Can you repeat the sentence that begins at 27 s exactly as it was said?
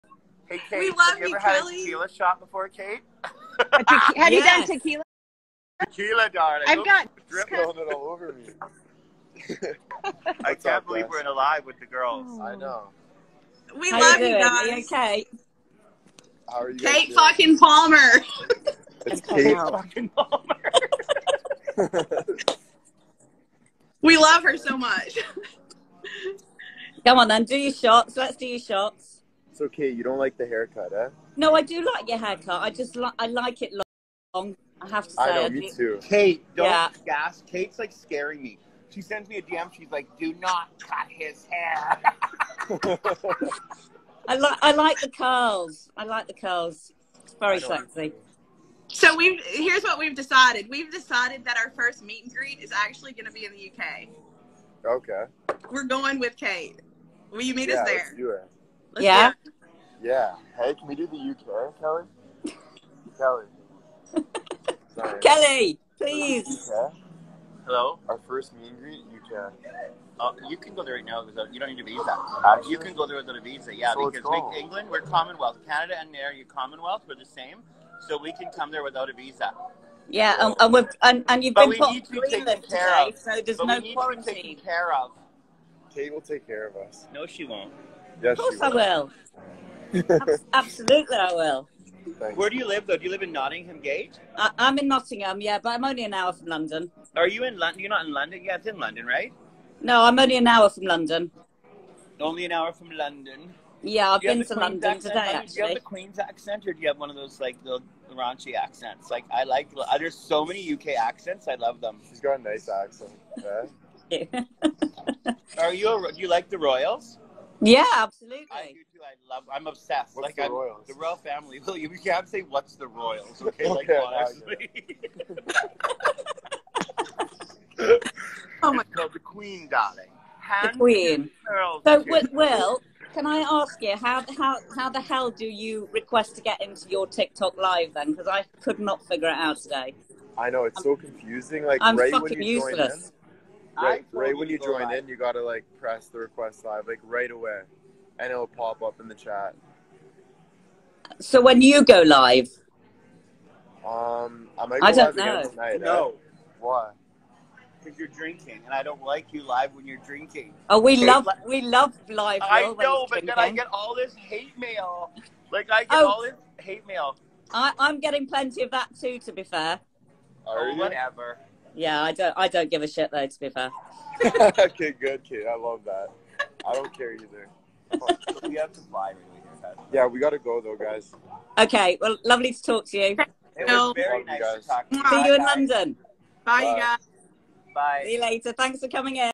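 Come on then, do your shots.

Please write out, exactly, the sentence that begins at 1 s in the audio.
had a tequila shot before, Kate?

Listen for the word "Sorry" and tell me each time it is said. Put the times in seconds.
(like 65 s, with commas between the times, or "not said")
64 s.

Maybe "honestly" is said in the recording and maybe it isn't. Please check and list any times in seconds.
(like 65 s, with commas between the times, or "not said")
124 s.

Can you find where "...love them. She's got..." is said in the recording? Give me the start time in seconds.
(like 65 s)
111 s.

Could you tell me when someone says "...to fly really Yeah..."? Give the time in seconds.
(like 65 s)
178 s.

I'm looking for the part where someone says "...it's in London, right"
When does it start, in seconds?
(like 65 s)
98 s.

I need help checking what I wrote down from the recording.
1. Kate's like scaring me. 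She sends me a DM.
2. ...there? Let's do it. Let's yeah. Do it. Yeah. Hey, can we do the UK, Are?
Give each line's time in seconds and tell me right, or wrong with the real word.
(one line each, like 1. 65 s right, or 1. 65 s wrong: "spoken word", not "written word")
1. 37 s right
2. 57 s wrong: "Kelly", not "Are".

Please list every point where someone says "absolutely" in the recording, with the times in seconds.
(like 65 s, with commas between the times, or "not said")
90 s, 117 s.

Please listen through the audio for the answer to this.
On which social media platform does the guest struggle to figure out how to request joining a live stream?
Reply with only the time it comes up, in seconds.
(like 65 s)
137 s.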